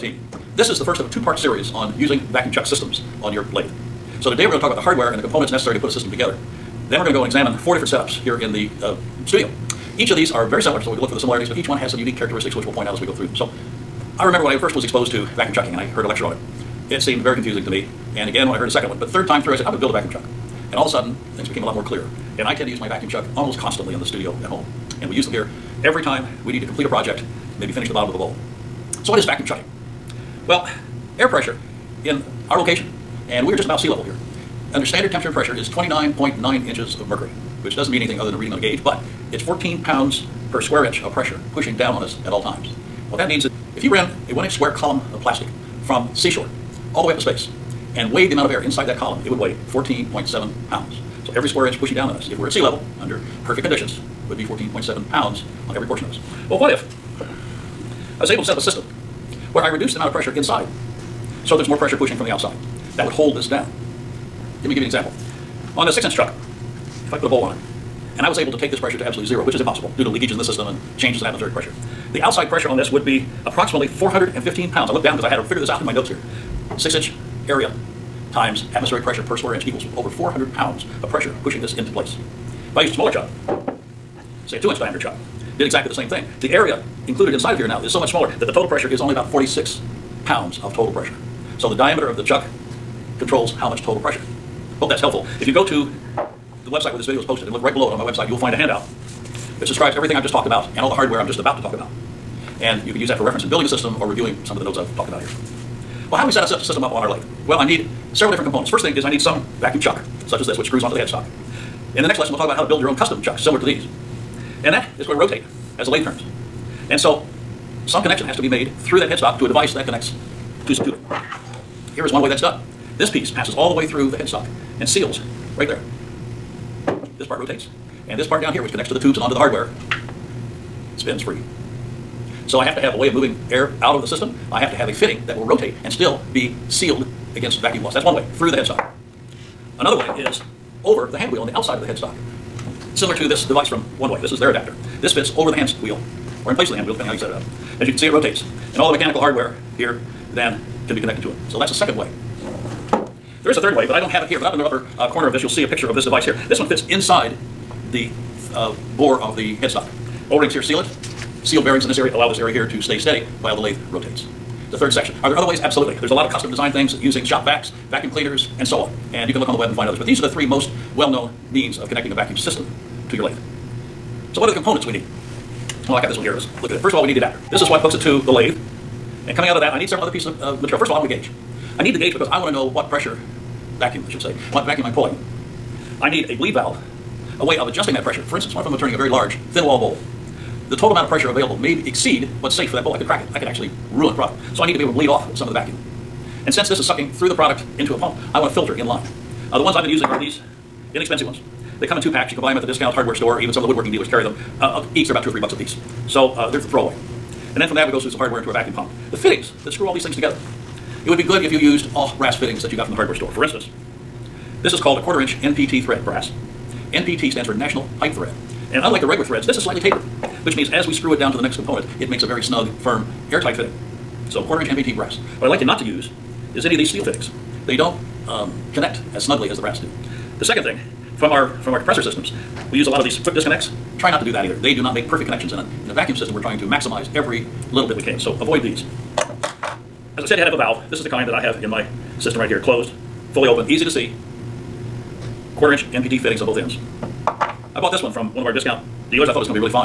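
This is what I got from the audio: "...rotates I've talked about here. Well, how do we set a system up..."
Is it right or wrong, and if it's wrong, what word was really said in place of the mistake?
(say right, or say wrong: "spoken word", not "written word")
wrong: "notes", not "rotates".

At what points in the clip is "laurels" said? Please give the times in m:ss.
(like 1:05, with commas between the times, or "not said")
not said.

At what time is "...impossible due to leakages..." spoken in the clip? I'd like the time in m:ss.
1:09.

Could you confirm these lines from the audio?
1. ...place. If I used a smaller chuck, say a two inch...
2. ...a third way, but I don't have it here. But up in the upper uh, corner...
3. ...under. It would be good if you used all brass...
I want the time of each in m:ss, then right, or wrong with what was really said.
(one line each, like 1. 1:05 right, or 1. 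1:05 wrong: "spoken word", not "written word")
1. 1:21 right
2. 2:33 right
3. 3:30 wrong: "together", not "under".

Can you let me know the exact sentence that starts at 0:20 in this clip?
And all of a sudden, things became a lot more clear.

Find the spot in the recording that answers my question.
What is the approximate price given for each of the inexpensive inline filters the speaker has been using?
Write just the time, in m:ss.
3:25.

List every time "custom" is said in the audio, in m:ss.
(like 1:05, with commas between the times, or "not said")
1:52, 2:46.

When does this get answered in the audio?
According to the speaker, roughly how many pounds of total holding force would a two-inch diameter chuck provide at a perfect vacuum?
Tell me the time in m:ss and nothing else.
1:29.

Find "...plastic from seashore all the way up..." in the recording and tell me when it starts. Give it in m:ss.
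0:45.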